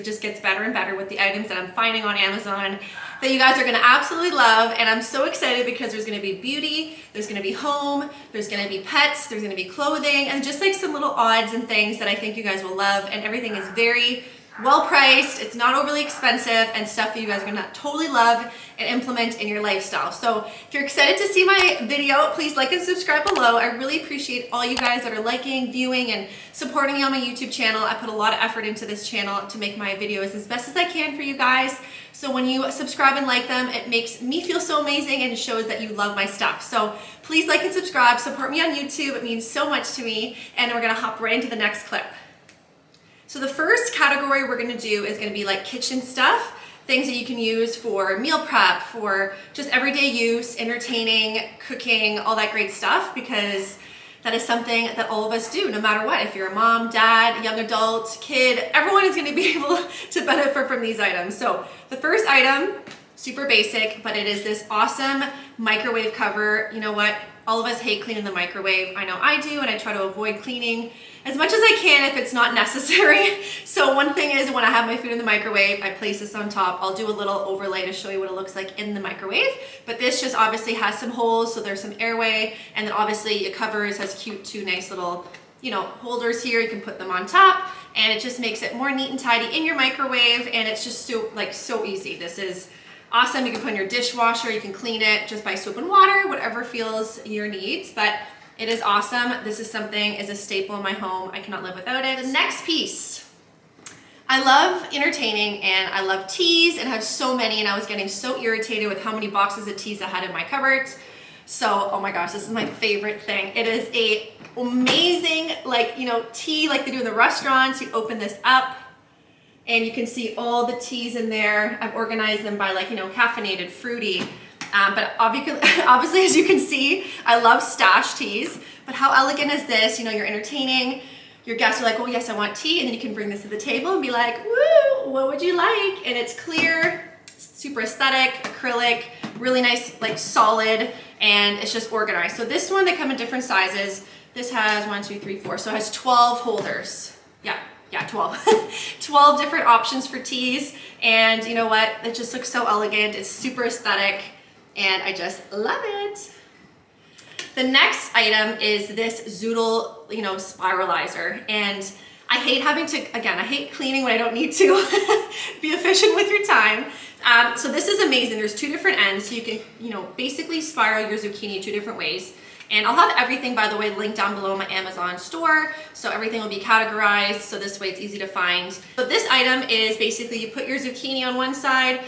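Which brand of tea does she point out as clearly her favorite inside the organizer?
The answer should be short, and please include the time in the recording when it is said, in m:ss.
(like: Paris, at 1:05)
Stash, at 2:07.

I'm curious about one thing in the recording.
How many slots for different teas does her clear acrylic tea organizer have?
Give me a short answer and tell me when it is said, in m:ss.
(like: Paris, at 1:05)
12, at 2:25.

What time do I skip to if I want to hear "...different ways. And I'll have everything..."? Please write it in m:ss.
2:51.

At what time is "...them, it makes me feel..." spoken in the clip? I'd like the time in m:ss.
0:33.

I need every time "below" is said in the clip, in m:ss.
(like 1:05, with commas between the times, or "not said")
0:23, 2:54.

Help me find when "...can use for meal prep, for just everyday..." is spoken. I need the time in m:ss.
0:47.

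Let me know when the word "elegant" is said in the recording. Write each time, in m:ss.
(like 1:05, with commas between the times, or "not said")
2:09, 2:32.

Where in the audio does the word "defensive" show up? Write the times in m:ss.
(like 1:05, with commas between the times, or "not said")
not said.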